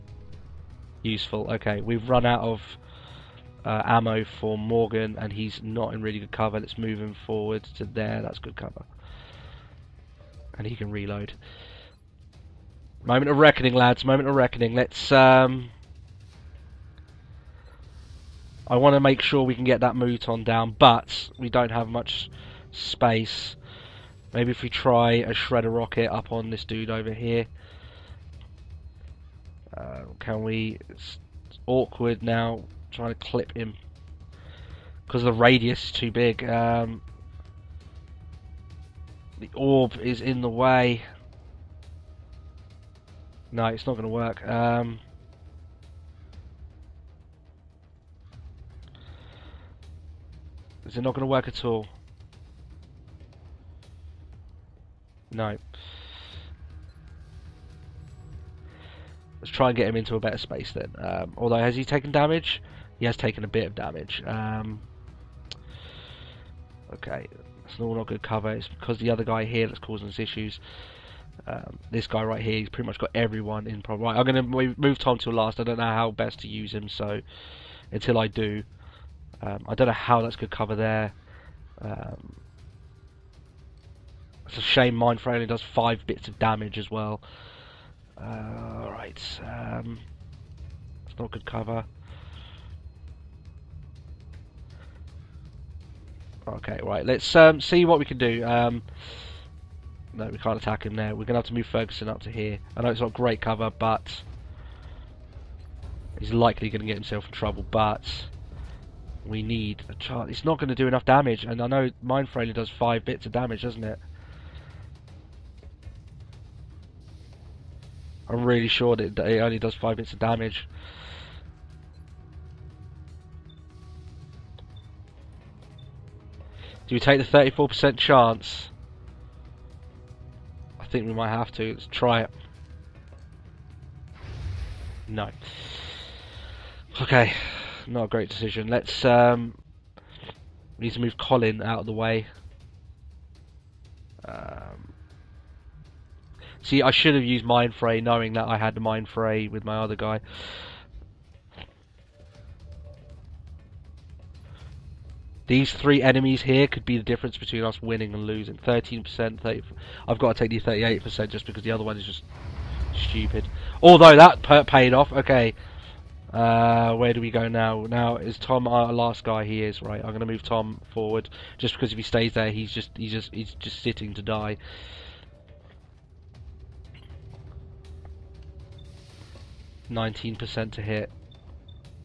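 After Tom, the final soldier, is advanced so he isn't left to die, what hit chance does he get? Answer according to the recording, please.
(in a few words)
19%.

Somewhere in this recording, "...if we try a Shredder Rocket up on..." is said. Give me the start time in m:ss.
0:24.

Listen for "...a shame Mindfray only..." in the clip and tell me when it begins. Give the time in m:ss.
1:24.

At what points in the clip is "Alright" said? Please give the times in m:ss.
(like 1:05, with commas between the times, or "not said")
1:28.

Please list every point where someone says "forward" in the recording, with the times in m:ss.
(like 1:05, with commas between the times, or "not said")
0:07, 2:50.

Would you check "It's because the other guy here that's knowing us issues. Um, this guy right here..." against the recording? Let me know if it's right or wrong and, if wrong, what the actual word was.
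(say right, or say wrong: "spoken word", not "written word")
wrong: "causing", not "knowing".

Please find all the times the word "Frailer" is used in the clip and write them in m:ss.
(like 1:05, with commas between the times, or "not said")
1:52.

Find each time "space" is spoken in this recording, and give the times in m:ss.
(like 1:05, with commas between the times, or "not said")
0:22, 1:00.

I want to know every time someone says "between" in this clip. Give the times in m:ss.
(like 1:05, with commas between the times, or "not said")
2:37.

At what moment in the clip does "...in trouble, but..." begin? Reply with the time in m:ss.
1:47.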